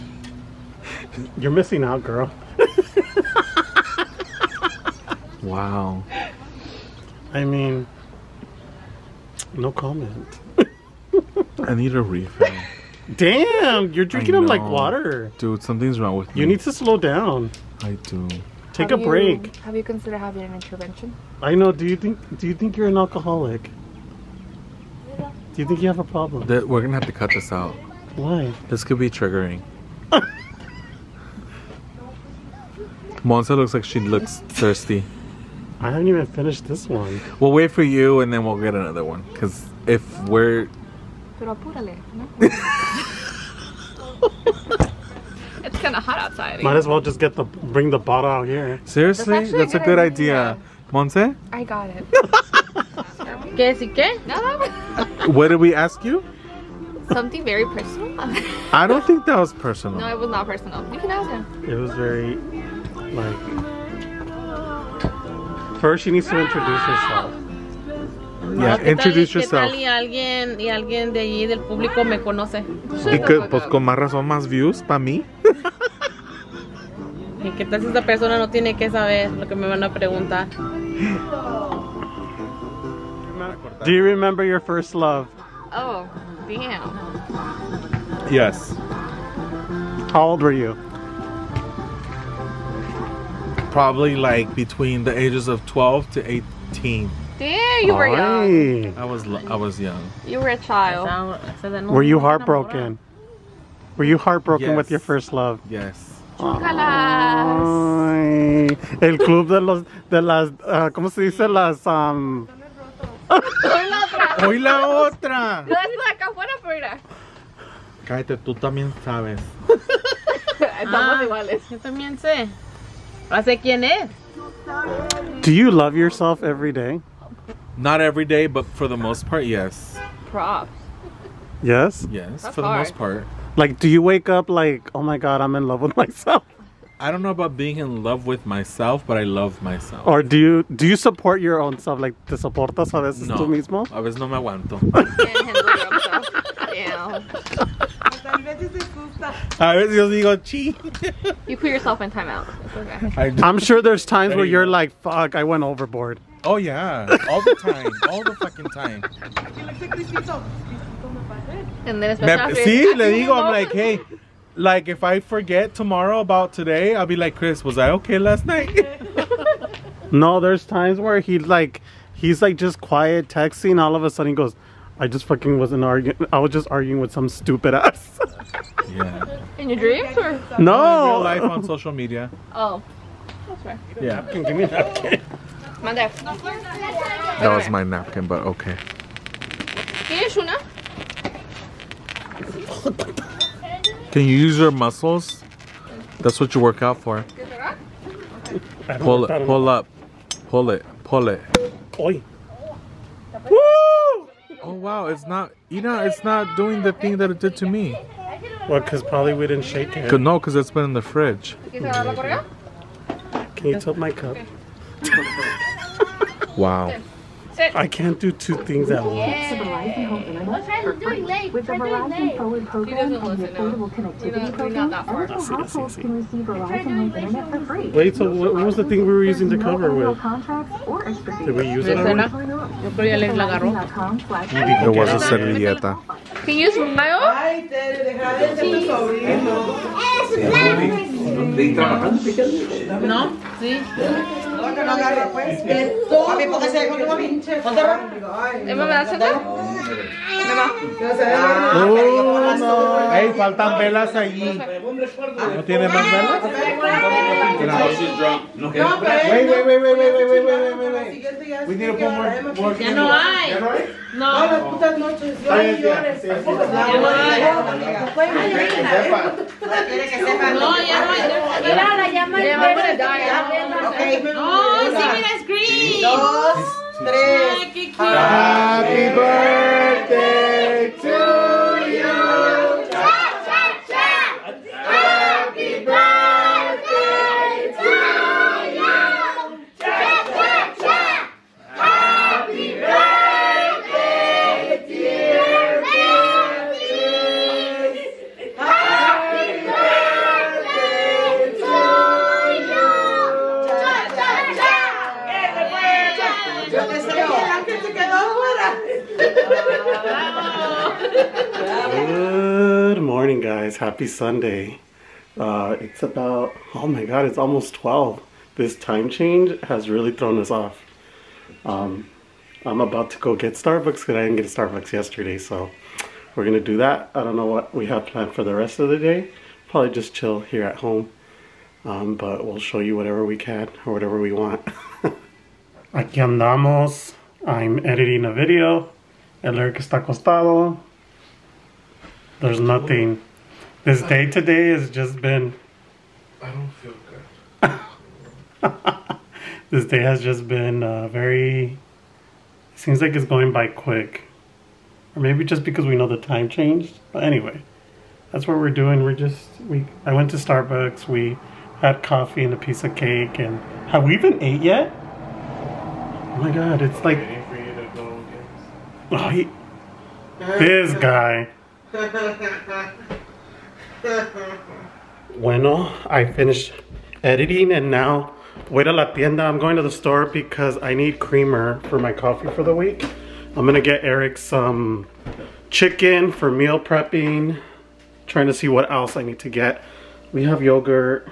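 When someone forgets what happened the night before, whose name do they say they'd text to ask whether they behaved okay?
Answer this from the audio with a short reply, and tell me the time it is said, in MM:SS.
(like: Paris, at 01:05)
Chris, at 02:47.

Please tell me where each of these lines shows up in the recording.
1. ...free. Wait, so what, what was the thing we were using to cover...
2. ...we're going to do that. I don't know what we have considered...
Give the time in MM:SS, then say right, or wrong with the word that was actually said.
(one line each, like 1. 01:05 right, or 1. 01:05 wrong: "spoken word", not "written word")
1. 03:47 right
2. 05:26 wrong: "planned", not "considered".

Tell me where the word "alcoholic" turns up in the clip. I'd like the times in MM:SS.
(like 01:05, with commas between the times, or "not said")
00:22.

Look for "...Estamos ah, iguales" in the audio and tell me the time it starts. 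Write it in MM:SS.
02:00.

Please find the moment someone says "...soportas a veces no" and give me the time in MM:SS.
02:22.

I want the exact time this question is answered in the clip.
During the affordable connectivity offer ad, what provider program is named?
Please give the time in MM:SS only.
03:41.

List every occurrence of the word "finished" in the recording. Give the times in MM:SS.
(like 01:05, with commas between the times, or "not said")
00:36, 06:16.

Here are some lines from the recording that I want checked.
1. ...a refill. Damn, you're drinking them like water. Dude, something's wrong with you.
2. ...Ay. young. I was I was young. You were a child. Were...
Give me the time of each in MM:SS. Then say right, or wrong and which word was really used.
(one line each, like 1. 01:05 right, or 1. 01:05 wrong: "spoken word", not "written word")
1. 00:11 right
2. 01:38 right.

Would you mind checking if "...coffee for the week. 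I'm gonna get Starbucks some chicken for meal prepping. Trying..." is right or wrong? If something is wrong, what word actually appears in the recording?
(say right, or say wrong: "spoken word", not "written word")
wrong: "Eric", not "Starbucks".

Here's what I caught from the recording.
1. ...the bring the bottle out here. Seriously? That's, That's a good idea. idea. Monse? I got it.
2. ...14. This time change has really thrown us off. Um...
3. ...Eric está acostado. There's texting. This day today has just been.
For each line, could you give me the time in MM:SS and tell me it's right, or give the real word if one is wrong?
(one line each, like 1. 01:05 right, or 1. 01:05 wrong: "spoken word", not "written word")
1. 00:47 right
2. 05:17 wrong: "12", not "14"
3. 05:39 wrong: "nothing", not "texting".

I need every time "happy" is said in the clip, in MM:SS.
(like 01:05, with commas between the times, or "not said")
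04:37, 05:14.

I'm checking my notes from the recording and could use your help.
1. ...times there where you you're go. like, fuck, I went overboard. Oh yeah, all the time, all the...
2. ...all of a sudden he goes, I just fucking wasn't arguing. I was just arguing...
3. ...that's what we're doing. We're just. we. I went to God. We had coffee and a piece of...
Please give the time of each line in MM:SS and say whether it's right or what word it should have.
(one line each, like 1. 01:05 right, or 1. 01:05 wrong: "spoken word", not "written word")
1. 02:34 right
2. 02:53 right
3. 05:58 wrong: "Starbucks", not "God".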